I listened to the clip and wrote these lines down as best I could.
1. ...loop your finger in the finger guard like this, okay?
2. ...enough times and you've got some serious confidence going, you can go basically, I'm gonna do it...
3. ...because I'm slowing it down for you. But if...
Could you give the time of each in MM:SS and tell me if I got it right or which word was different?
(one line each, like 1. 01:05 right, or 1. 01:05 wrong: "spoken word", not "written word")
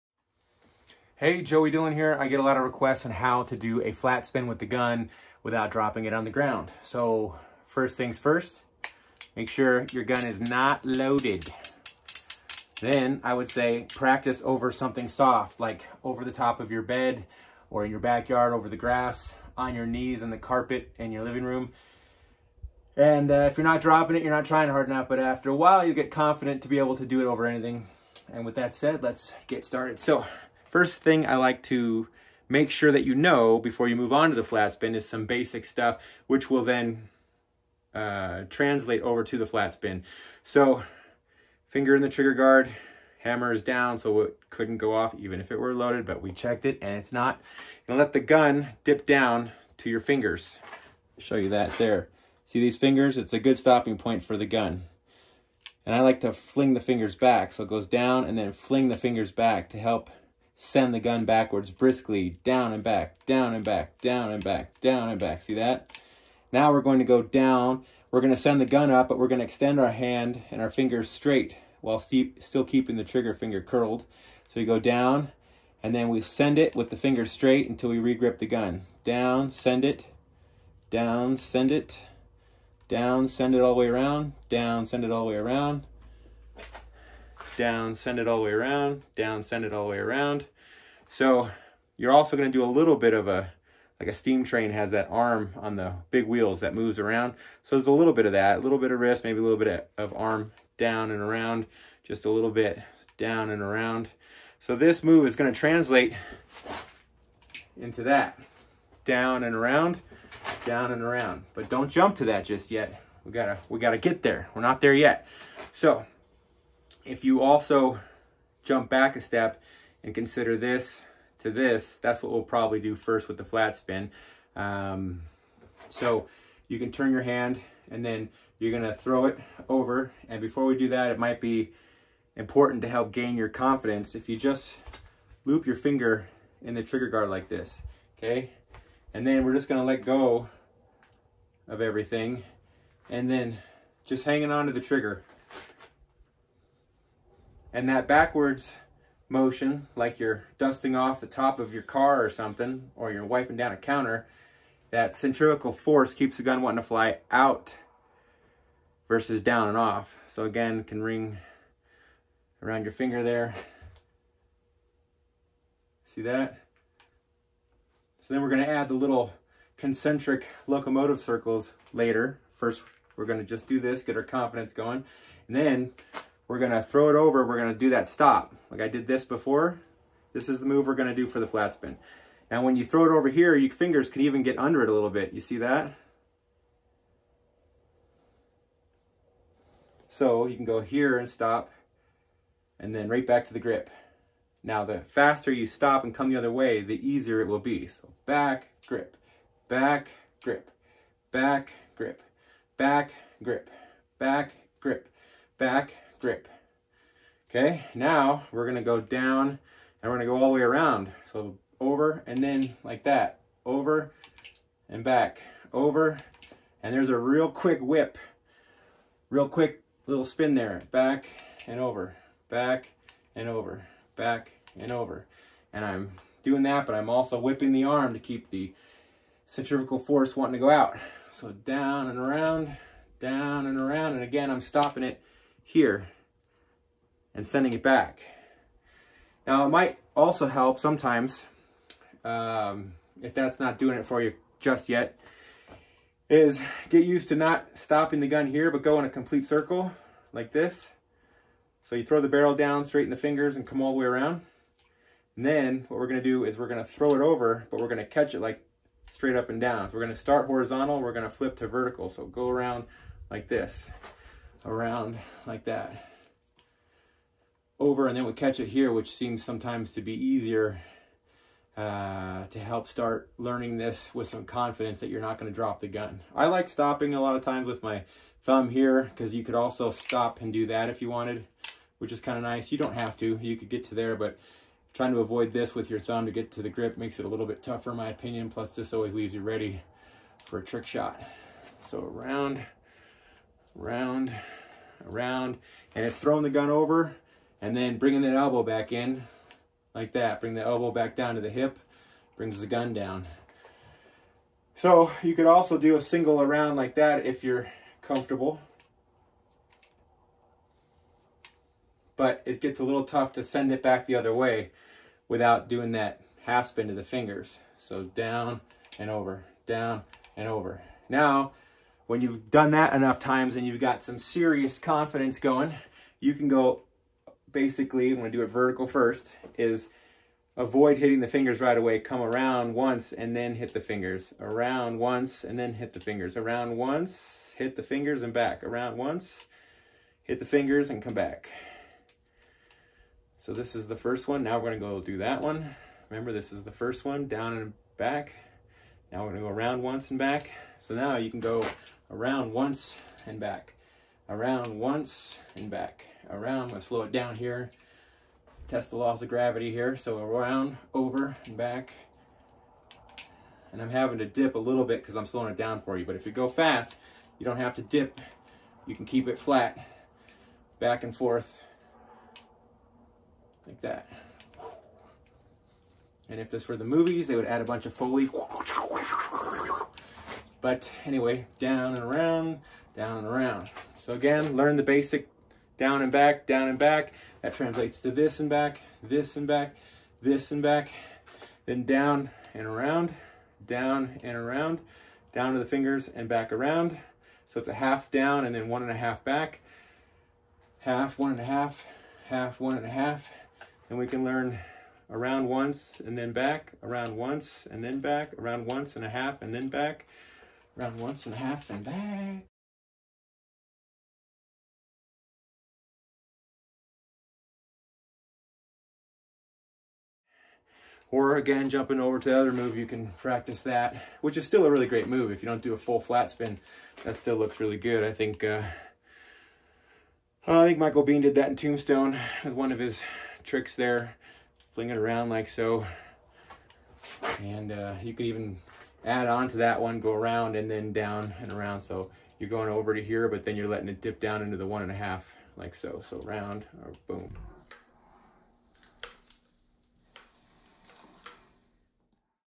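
1. 02:15 wrong: "trigger", not "finger"
2. 05:22 right
3. 06:05 right.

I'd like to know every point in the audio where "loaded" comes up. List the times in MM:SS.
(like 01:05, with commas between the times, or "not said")
00:10, 00:45.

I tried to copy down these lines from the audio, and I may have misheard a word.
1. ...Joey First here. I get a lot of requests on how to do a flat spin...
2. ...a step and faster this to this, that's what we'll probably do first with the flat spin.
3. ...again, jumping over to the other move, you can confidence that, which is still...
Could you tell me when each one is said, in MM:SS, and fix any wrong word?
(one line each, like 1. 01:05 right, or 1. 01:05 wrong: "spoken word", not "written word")
1. 00:01 wrong: "Dillon", not "First"
2. 01:59 wrong: "consider", not "faster"
3. 07:01 wrong: "practice", not "confidence".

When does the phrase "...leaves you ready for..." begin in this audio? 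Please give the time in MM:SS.
04:49.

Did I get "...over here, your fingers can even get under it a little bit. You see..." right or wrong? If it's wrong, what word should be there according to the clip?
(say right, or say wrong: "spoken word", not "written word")
right.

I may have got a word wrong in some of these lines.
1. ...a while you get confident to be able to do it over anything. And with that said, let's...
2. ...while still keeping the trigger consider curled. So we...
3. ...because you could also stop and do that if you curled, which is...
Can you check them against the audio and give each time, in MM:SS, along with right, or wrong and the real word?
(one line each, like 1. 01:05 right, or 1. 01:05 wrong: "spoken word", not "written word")
1. 00:25 right
2. 01:11 wrong: "finger", not "consider"
3. 04:39 wrong: "wanted", not "curled".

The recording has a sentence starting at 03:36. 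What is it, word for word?
And there's a real quick whip, real quick little spin there.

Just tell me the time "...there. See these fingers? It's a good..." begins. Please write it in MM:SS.
00:51.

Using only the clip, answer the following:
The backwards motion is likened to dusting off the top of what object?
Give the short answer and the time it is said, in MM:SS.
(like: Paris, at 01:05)
car, at 02:31.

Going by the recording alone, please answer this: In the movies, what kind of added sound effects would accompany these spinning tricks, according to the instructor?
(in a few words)
Foley.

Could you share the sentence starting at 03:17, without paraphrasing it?
So back, grip, back, grip, back, grip, back, grip, back, grip, back, grip.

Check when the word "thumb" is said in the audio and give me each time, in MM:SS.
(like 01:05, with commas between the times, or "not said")
04:38, 04:45.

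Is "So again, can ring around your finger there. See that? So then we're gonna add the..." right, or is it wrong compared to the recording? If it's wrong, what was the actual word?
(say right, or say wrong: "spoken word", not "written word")
right.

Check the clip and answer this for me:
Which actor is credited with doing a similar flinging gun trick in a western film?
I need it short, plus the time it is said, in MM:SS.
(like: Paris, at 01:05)
Michael Biehn, at 07:10.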